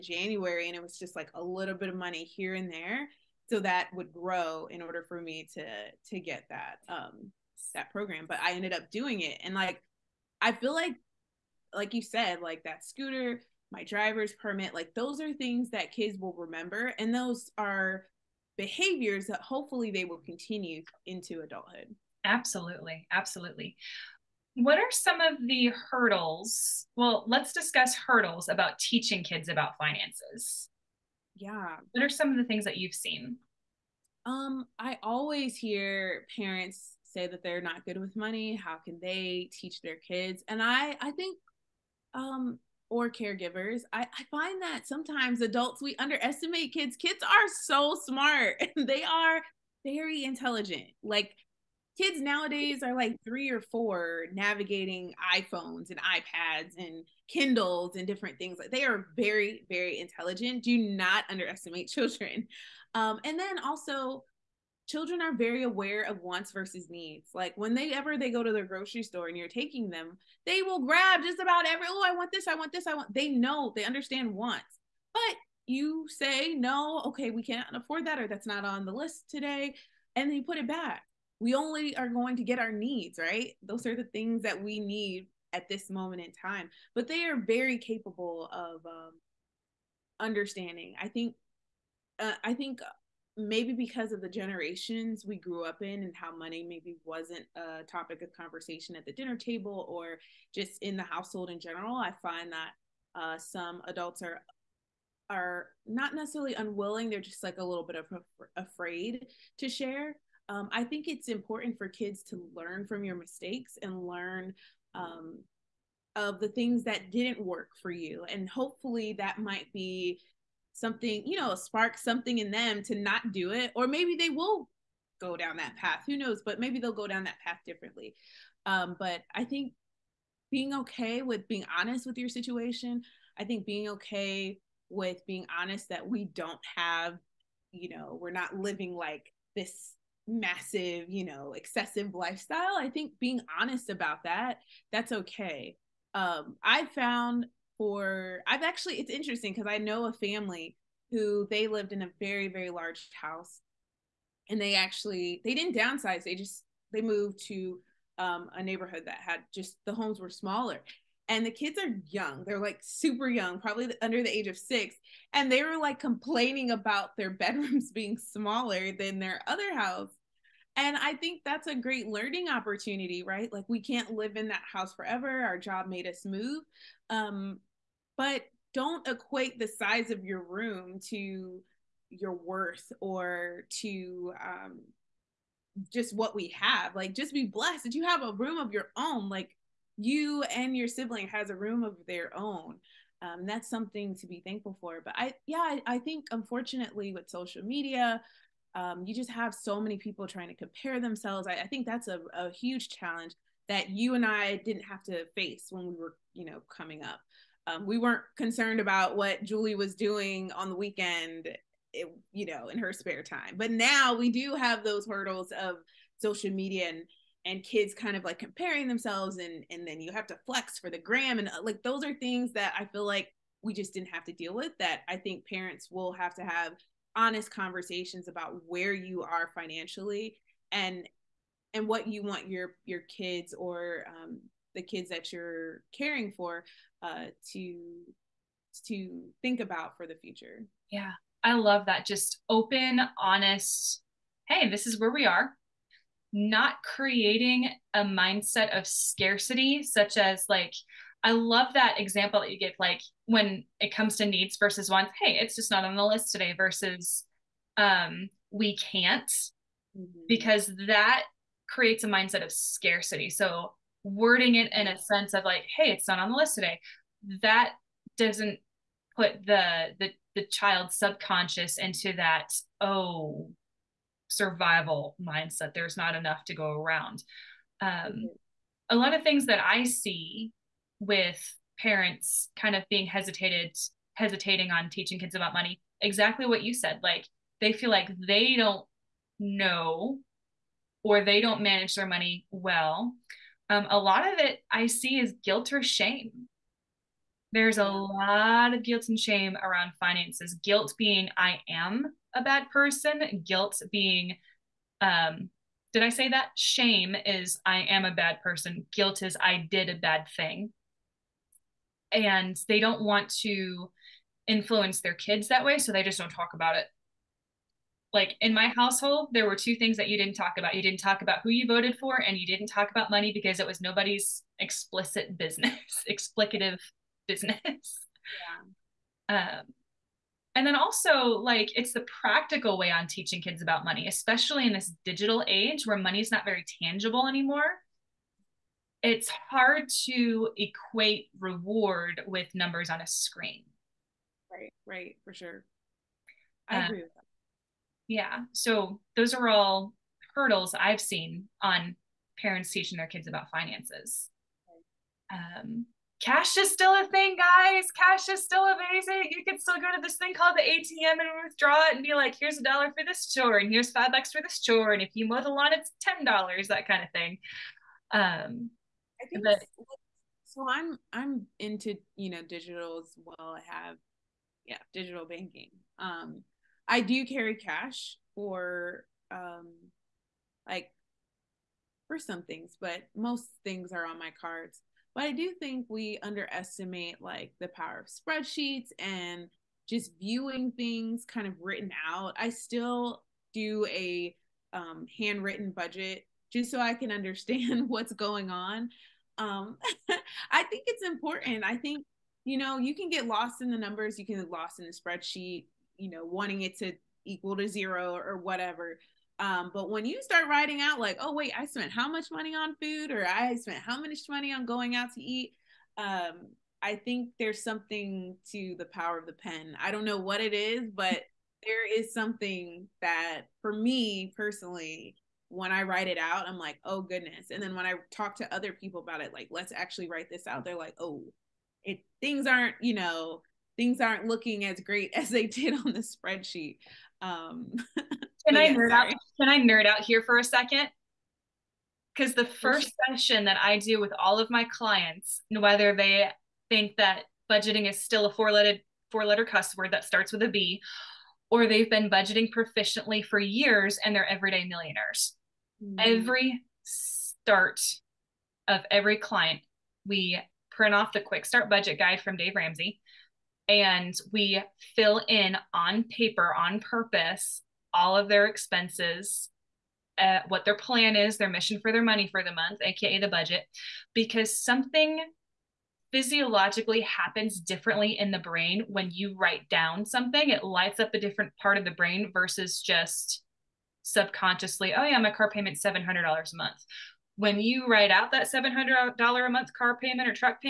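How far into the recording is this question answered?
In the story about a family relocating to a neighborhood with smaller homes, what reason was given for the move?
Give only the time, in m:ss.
2:55.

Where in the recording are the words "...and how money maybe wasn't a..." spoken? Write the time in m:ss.
1:36.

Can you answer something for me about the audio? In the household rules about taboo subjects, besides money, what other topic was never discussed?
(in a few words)
who you voted for.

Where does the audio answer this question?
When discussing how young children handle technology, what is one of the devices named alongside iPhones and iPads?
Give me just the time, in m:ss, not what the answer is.
0:57.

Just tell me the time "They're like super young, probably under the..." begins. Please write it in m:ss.
2:42.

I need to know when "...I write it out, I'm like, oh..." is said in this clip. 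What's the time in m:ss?
7:05.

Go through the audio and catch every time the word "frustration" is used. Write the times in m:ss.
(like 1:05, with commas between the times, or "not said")
not said.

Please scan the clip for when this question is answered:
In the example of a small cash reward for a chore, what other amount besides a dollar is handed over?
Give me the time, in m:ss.
6:03.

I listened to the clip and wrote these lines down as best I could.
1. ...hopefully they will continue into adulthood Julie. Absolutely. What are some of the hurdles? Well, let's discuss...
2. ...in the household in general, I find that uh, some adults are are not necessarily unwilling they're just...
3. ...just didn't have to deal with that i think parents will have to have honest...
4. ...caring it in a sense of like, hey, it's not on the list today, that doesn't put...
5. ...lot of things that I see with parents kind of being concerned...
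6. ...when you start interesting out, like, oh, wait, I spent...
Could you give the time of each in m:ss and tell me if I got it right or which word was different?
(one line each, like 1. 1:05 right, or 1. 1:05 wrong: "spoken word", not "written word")
1. 0:19 wrong: "Absolutely", not "Julie"
2. 1:40 right
3. 3:43 right
4. 4:24 wrong: "wording", not "caring"
5. 4:38 wrong: "hesitated", not "concerned"
6. 6:49 wrong: "writing", not "interesting".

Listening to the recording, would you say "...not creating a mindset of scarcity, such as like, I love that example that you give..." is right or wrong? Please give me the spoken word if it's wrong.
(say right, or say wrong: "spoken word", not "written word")
right.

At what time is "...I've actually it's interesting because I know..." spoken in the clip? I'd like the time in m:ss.
2:28.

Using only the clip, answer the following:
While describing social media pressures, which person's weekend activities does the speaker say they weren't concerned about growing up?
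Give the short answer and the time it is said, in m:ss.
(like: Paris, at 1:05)
Julie, at 3:29.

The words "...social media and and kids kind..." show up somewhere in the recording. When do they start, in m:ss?
3:36.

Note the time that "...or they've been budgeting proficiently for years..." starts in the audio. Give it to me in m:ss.
7:31.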